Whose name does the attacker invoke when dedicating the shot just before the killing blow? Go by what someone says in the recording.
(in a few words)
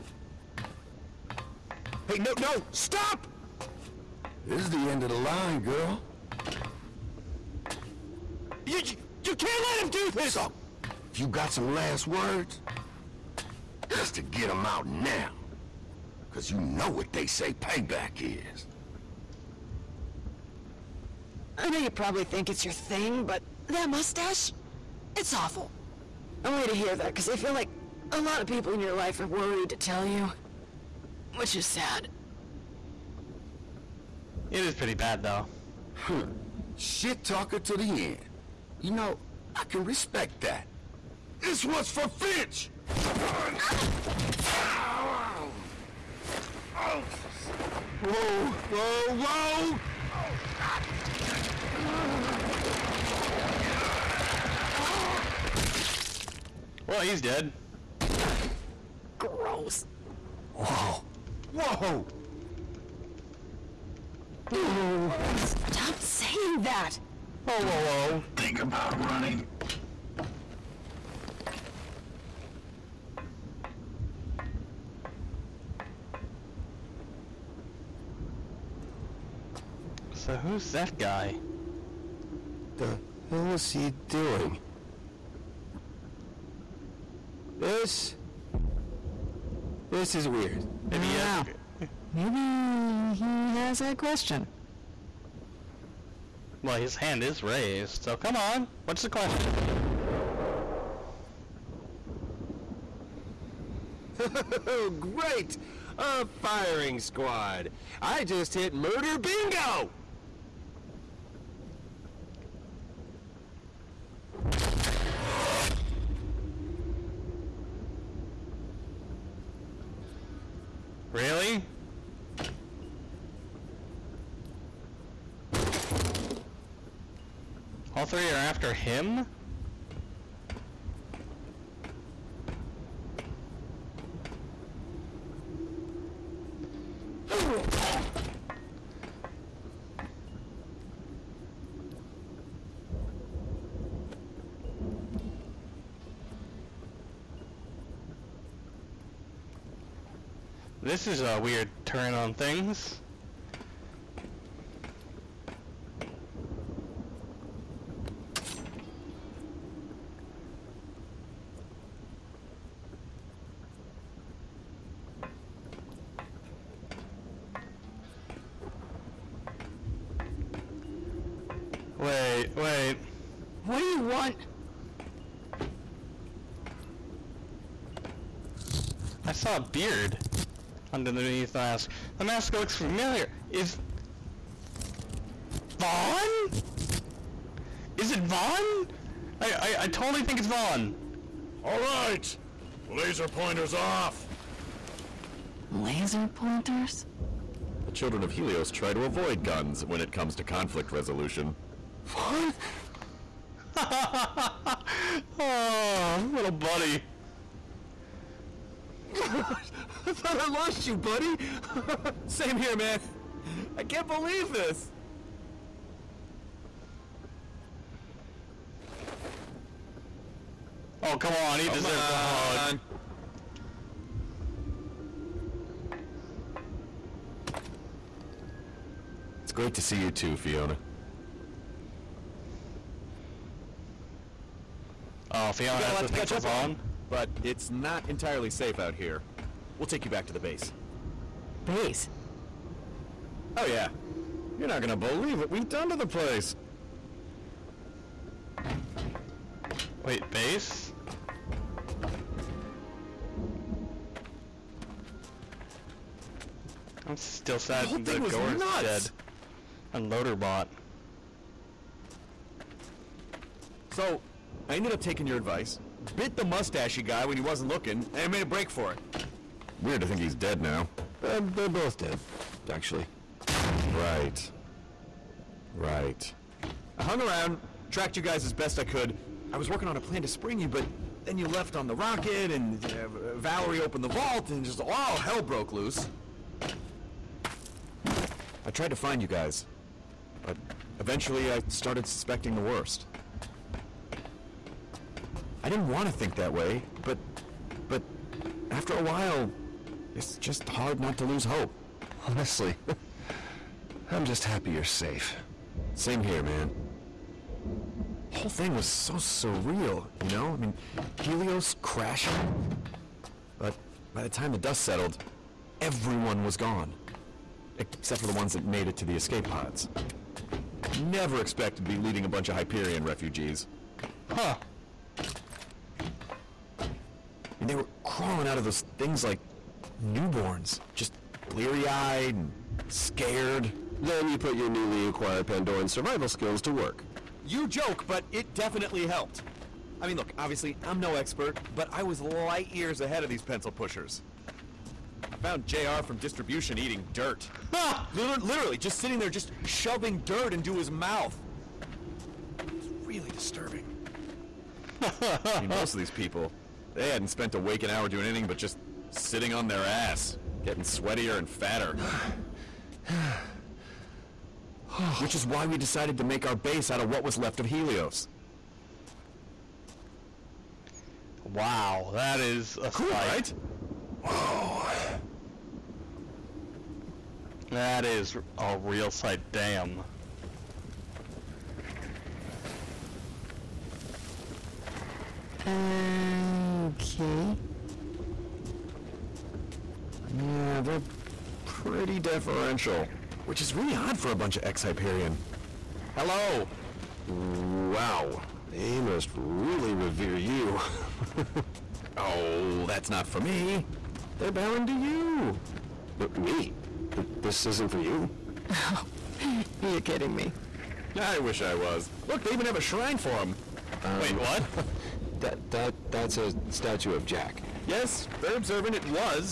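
Finch.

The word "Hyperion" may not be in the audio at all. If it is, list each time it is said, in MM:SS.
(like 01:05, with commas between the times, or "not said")
05:22, 06:34.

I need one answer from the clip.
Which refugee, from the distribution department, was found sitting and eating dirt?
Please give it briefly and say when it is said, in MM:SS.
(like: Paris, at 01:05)
JR, at 05:45.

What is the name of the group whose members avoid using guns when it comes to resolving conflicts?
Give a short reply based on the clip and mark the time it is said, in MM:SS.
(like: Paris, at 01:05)
The children of Helios, at 03:17.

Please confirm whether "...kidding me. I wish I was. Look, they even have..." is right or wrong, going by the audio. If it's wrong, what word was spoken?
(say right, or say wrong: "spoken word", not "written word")
right.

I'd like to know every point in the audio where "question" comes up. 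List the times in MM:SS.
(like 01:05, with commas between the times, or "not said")
01:33, 01:39.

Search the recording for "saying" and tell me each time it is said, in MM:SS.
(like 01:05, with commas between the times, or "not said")
01:05.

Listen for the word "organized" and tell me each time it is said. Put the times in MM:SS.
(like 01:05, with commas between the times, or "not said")
not said.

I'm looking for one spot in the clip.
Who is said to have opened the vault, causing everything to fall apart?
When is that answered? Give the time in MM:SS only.
04:43.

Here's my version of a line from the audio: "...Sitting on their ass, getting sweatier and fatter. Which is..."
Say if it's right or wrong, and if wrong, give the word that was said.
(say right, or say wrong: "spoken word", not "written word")
right.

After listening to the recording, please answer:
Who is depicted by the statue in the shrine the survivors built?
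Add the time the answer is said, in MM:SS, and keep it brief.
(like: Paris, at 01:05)
Jack, at 06:57.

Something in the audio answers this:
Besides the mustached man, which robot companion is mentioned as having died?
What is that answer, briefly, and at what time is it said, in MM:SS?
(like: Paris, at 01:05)
Loaderbot, at 04:20.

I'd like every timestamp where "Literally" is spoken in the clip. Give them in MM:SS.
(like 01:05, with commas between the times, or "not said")
05:48.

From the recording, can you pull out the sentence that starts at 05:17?
Except for the ones that made it to the escape pods.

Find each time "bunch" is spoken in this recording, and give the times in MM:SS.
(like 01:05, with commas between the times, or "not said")
05:22, 06:34.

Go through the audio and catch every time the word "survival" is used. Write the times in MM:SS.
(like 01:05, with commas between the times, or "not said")
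05:35.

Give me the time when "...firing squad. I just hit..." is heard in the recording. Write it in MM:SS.
01:46.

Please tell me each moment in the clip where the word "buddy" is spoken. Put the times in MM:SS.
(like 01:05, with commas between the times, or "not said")
03:26, 03:30.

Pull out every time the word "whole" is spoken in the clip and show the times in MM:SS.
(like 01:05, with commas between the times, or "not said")
04:17, 05:08.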